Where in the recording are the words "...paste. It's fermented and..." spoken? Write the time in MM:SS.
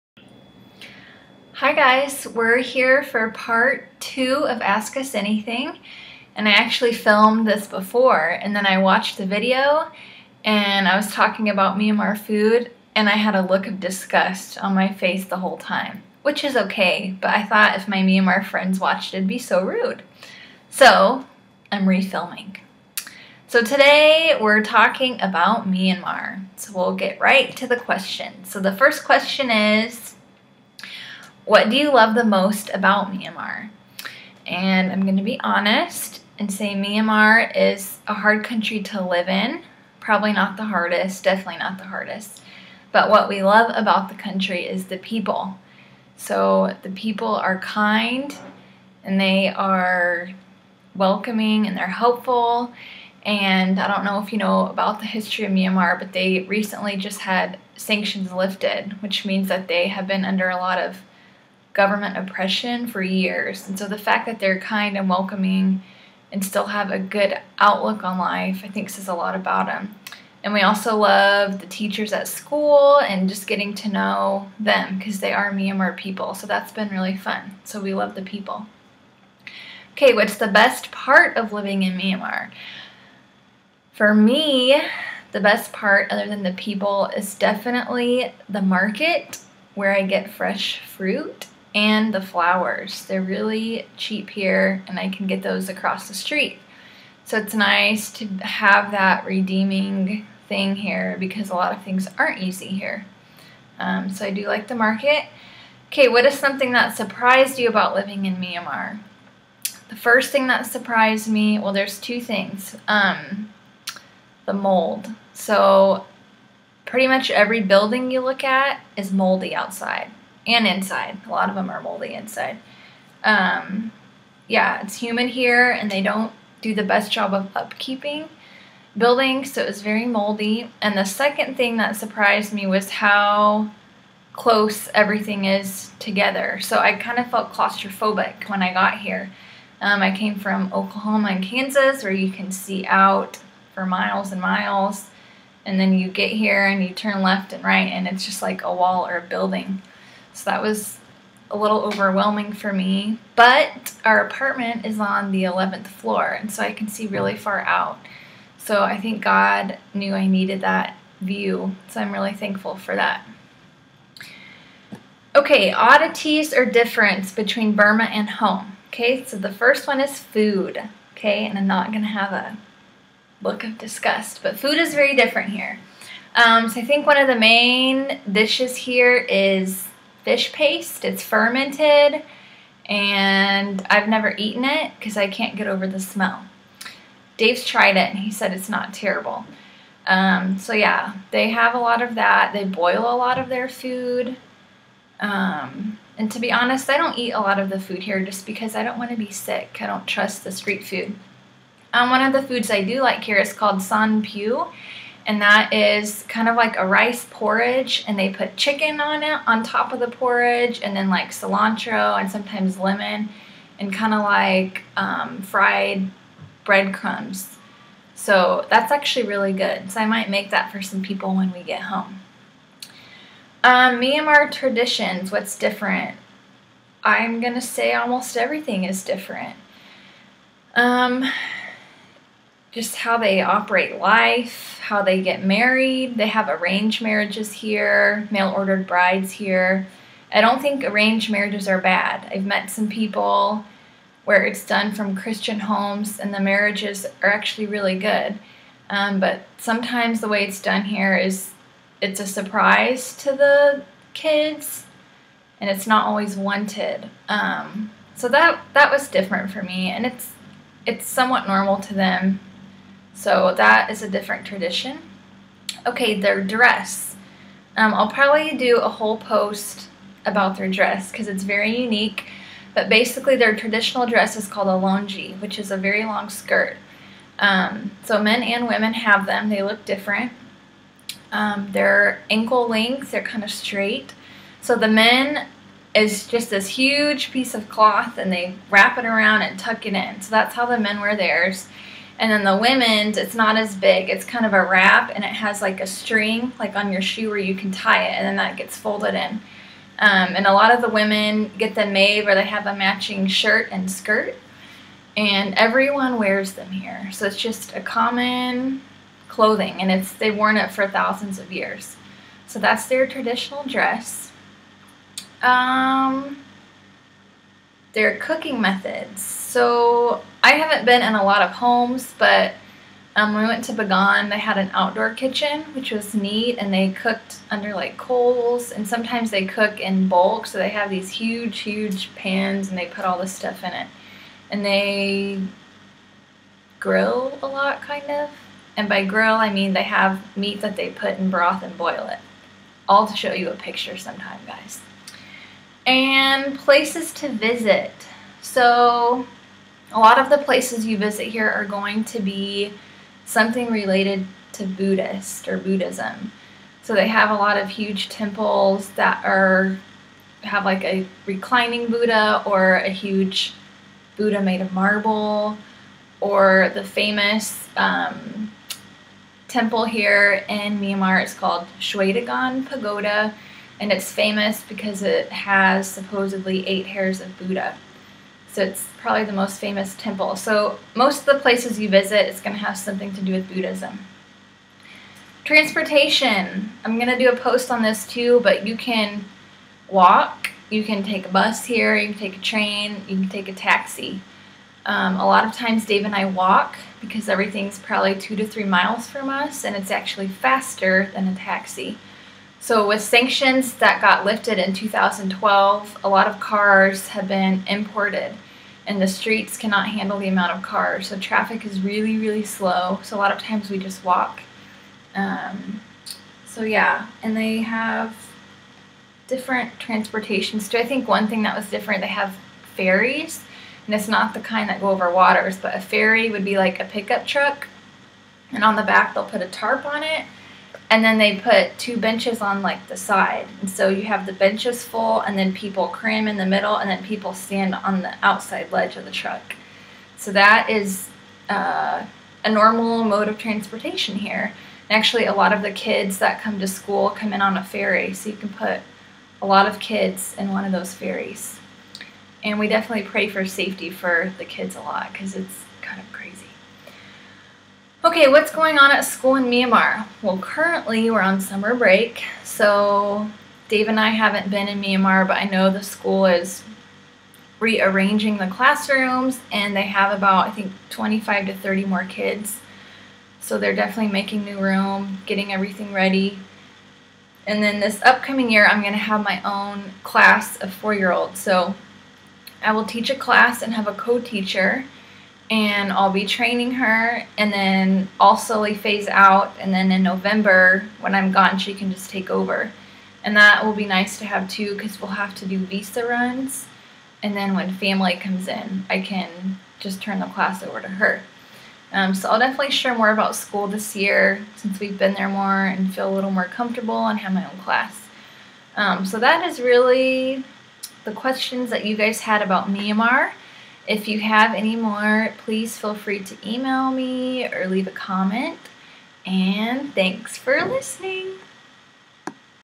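03:00.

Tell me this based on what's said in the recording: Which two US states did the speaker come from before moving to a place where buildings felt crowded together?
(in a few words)
Oklahoma and Kansas.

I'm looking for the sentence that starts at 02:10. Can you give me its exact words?
And the second thing that surprised me was how close everything is together.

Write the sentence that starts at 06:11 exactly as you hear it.
is called Shwedagon Pagoda and it's famous because it has supposedly eight hairs of Buddha.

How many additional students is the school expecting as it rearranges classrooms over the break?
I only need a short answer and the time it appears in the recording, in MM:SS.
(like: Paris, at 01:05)
25 to 30, at 07:50.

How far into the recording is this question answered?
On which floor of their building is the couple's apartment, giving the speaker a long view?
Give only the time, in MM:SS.
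02:35.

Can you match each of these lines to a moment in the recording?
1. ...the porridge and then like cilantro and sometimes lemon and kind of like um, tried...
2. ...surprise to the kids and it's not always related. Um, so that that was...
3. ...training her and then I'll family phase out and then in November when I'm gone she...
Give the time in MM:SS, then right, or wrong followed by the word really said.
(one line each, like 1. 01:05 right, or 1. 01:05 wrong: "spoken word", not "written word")
1. 03:29 wrong: "fried", not "tried"
2. 04:12 wrong: "wanted", not "related"
3. 08:06 wrong: "slowly", not "family".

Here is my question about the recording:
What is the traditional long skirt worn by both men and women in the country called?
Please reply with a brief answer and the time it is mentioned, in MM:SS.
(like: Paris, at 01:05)
Longi, at 04:34.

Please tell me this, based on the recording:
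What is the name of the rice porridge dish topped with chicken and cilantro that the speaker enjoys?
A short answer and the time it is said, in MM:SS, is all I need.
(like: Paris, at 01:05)
San Piu, at 03:23.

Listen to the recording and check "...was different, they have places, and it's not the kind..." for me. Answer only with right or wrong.
wrong.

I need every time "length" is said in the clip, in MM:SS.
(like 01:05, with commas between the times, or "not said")
04:42.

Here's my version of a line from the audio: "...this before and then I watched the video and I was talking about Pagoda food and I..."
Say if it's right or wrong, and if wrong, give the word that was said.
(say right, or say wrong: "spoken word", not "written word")
wrong: "Myanmar", not "Pagoda".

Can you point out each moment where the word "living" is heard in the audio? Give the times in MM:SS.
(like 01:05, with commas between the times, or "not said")
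01:21, 01:47.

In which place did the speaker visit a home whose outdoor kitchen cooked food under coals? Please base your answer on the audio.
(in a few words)
Begon.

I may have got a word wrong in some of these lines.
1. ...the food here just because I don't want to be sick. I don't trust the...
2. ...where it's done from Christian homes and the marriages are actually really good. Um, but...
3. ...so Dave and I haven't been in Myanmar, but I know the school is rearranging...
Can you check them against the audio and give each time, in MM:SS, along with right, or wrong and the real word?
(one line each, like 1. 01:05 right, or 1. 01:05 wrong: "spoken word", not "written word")
1. 03:17 right
2. 04:04 right
3. 07:42 right.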